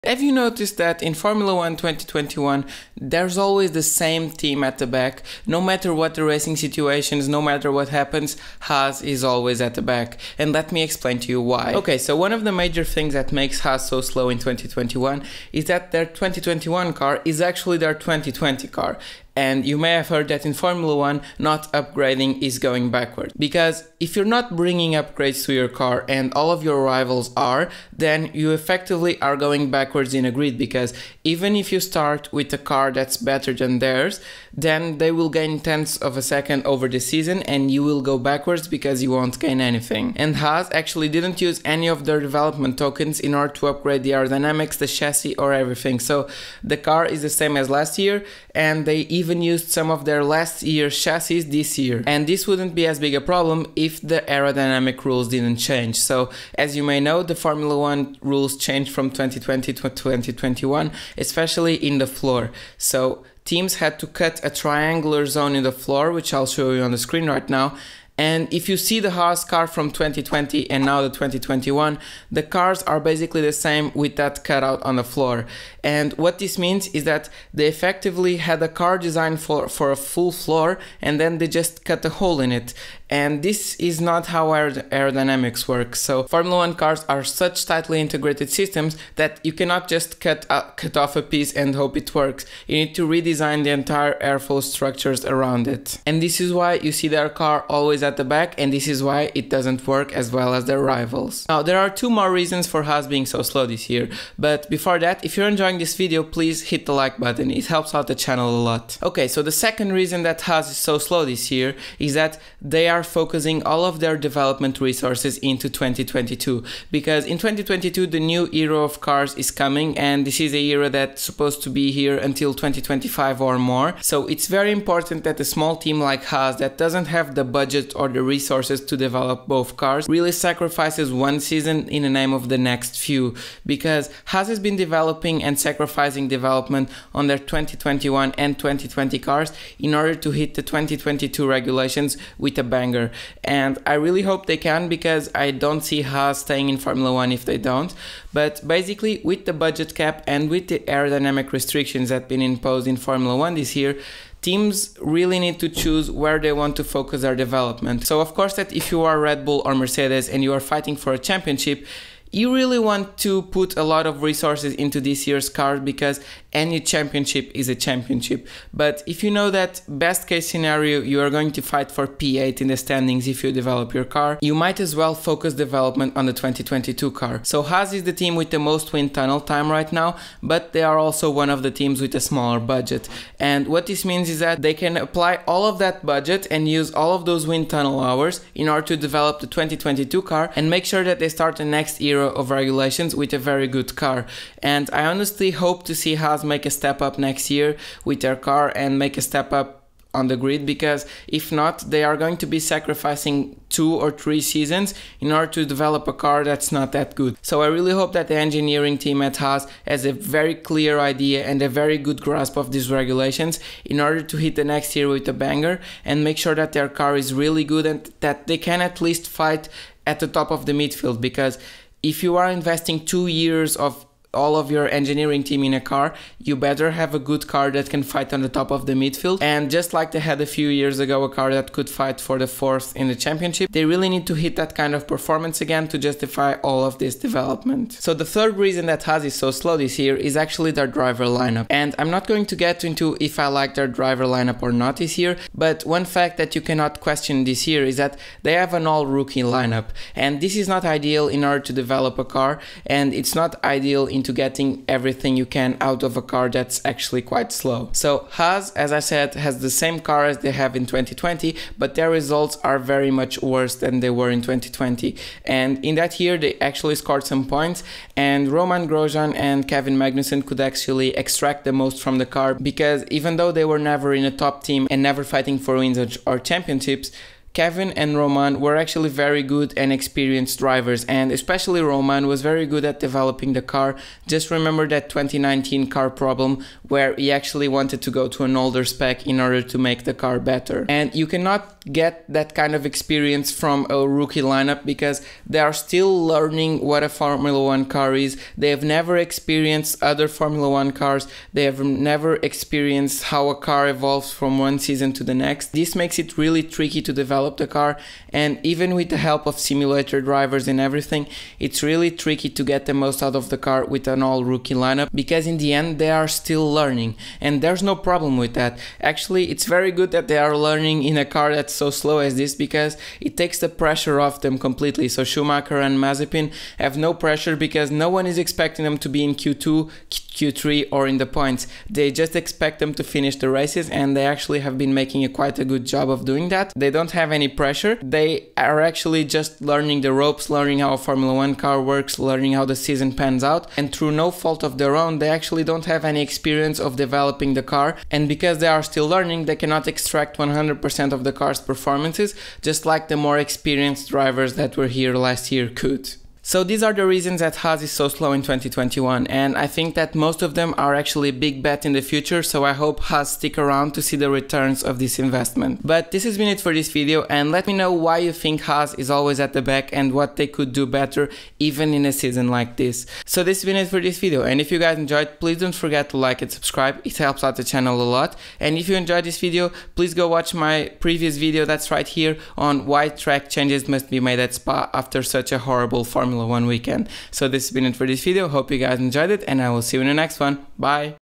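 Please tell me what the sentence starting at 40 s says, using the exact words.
And Haas actually didn't use any of their development tokens in order to upgrade the aerodynamics, the chassis or everything.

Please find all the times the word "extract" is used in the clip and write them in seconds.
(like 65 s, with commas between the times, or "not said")
271 s, 349 s.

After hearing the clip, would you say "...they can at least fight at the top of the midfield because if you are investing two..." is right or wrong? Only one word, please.
right.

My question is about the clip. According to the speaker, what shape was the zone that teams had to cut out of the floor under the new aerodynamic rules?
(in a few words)
Triangular.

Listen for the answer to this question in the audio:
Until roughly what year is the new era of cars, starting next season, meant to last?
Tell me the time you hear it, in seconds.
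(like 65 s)
122 s.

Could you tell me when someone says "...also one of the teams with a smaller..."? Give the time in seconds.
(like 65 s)
180 s.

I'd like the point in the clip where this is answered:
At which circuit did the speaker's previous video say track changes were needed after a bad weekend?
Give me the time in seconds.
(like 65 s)
384 s.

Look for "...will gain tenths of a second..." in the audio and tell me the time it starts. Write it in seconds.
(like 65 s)
35 s.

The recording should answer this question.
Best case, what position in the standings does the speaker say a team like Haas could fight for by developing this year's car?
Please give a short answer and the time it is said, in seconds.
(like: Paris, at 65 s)
P8, at 172 s.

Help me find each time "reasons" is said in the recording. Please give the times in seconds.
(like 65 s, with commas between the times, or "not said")
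102 s, 109 s, 238 s, 357 s.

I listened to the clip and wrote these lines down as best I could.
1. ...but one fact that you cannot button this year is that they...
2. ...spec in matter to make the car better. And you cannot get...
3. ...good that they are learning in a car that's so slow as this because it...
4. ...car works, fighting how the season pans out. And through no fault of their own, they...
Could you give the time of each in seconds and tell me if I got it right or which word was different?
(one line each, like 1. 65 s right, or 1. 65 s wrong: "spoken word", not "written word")
1. 245 s wrong: "question", not "button"
2. 288 s wrong: "order", not "matter"
3. 319 s right
4. 341 s wrong: "learning", not "fighting".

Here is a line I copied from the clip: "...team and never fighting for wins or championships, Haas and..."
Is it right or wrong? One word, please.
wrong.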